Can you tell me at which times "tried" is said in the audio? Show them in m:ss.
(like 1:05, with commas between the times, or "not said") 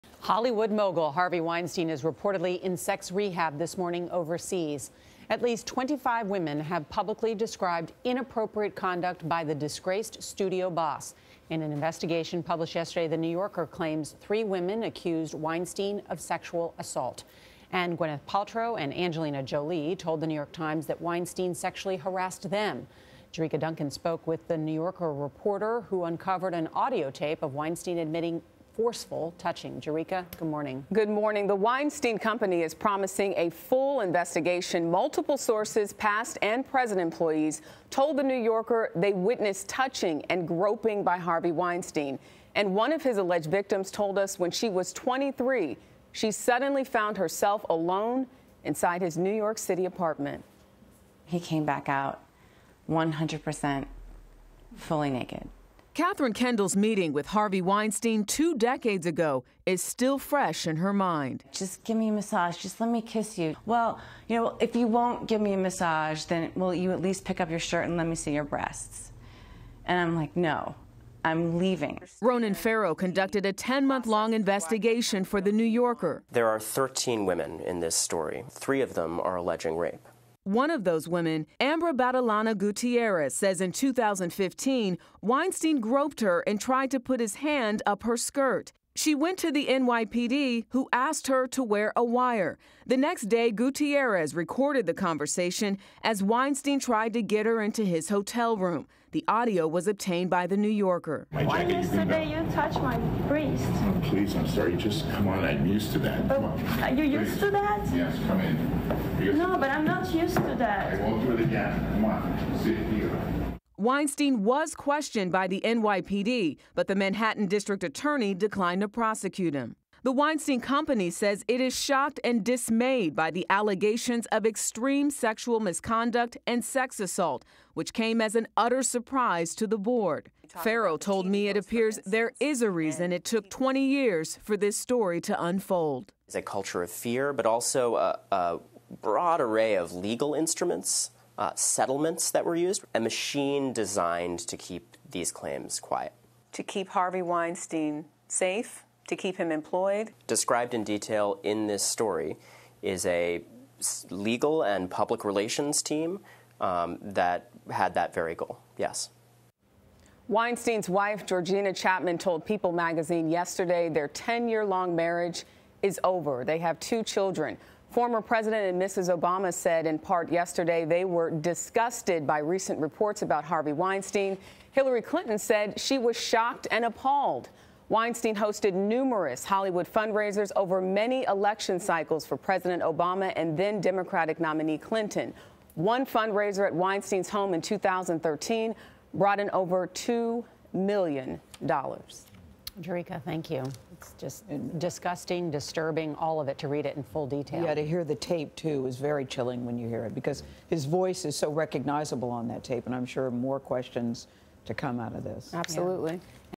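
1:26, 1:36.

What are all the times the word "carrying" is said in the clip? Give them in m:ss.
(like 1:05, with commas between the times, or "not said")
not said.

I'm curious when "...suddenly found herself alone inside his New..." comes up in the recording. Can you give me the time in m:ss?
0:46.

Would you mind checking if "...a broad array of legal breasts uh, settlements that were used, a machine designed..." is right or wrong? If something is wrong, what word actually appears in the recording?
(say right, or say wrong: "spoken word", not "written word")
wrong: "instruments", not "breasts".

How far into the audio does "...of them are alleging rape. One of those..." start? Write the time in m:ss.
1:18.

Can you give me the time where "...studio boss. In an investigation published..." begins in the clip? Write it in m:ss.
0:10.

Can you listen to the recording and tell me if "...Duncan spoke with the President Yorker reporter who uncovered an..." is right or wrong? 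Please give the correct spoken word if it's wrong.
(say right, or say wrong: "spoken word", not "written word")
wrong: "New", not "President".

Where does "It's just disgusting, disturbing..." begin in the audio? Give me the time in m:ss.
3:13.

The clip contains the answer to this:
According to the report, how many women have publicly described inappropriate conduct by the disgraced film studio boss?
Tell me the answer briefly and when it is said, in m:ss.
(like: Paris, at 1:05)
25, at 0:05.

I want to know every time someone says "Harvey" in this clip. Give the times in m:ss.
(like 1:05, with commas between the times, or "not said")
0:01, 0:41, 0:57, 2:26, 2:53.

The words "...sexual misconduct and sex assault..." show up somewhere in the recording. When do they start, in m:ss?
2:05.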